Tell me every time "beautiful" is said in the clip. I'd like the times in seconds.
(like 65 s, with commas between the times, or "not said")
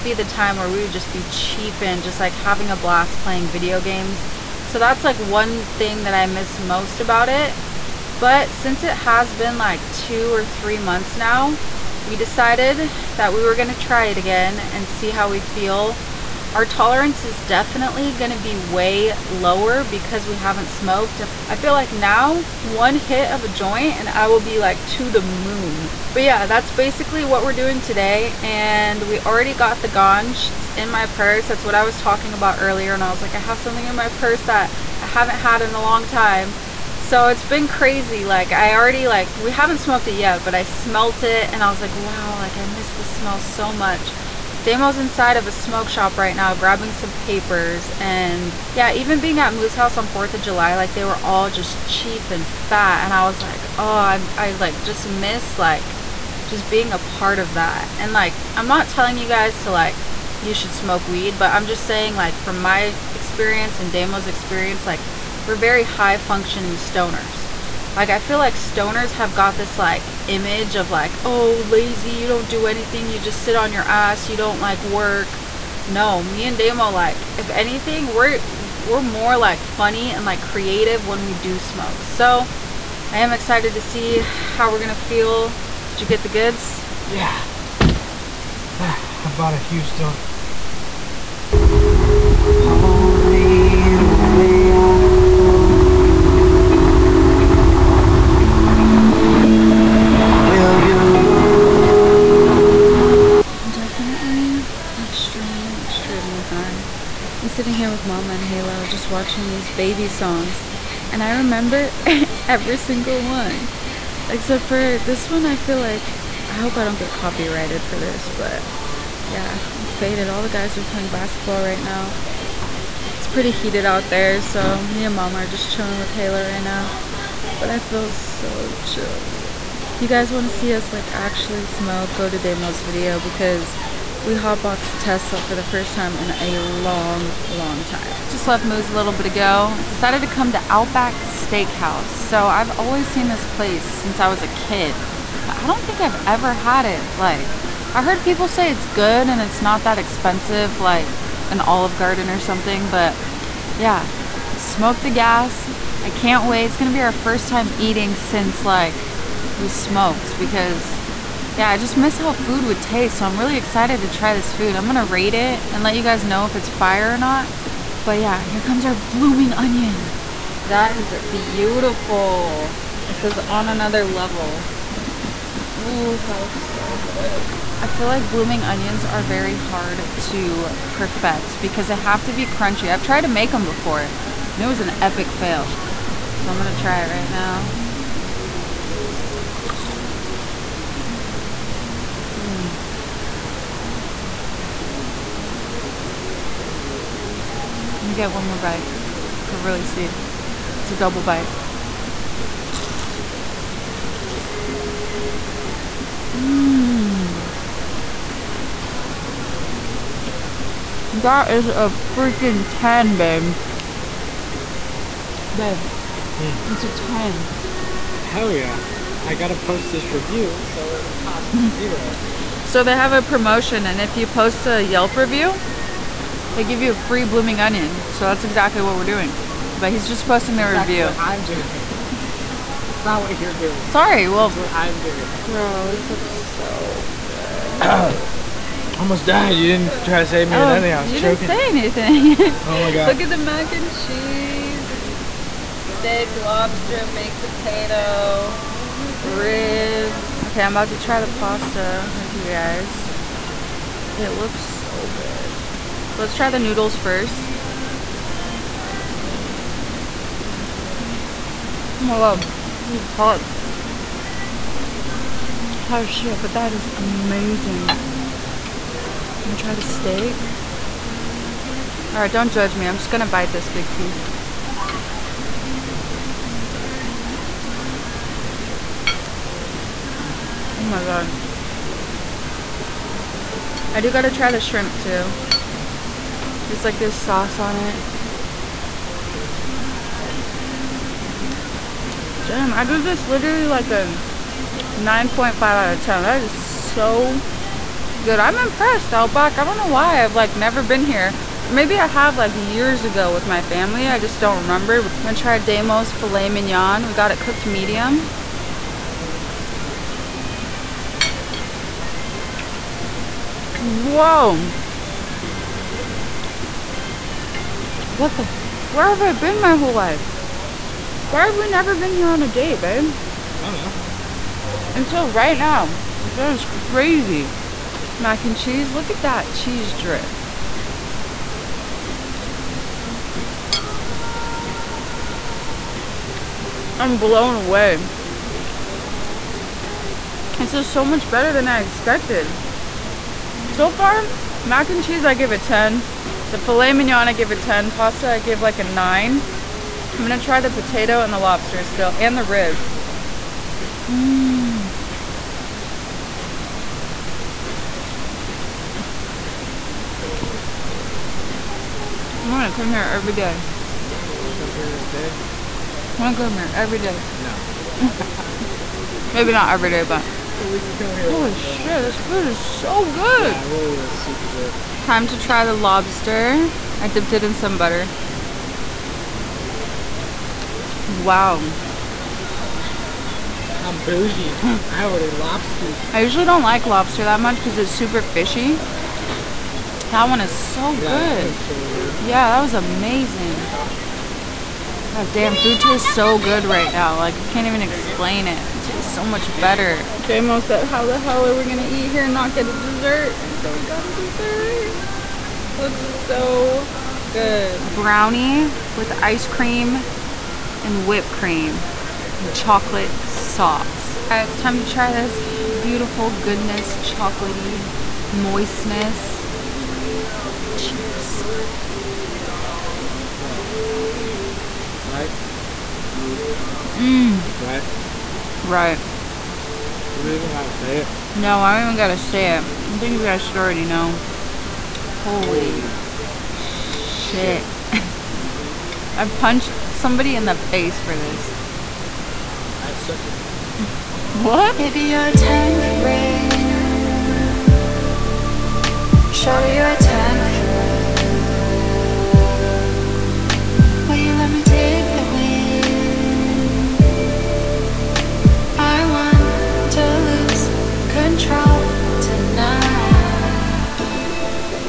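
171 s, 415 s.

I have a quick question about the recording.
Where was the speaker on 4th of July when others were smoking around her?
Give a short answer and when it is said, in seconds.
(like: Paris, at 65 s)
Moose's house, at 49 s.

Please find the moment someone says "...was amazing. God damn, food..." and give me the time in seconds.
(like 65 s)
392 s.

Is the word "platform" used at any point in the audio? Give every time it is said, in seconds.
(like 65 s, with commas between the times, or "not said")
not said.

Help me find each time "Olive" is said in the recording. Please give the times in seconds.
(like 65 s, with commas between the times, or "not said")
151 s.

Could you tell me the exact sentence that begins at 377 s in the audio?
I dipped it in some butter.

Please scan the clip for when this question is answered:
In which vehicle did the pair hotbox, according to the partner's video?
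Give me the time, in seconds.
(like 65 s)
135 s.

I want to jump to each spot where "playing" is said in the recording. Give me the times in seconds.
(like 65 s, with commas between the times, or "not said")
3 s, 120 s.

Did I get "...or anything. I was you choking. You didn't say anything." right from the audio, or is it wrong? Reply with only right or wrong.
right.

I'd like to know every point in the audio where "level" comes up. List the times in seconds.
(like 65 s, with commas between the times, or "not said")
174 s.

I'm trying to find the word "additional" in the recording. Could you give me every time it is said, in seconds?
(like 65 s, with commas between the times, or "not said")
not said.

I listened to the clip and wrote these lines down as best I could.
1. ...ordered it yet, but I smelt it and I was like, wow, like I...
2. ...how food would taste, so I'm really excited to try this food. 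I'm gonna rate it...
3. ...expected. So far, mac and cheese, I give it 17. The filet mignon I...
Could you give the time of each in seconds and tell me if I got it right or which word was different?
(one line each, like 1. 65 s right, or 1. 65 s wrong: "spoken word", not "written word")
1. 39 s wrong: "smoked", not "ordered"
2. 162 s right
3. 341 s wrong: "10", not "17".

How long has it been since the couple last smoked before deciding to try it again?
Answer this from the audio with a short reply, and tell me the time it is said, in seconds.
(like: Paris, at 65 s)
2 or 3 months, at 9 s.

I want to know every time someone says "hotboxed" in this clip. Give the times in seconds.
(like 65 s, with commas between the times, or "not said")
134 s.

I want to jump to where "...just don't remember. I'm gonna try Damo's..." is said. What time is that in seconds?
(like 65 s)
304 s.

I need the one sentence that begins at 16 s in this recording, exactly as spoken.
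Our tolerance is definitely gonna be way lower because we haven't smoked.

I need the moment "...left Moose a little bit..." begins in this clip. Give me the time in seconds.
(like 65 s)
138 s.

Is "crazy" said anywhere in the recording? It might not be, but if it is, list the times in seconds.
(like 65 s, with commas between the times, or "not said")
37 s, 326 s.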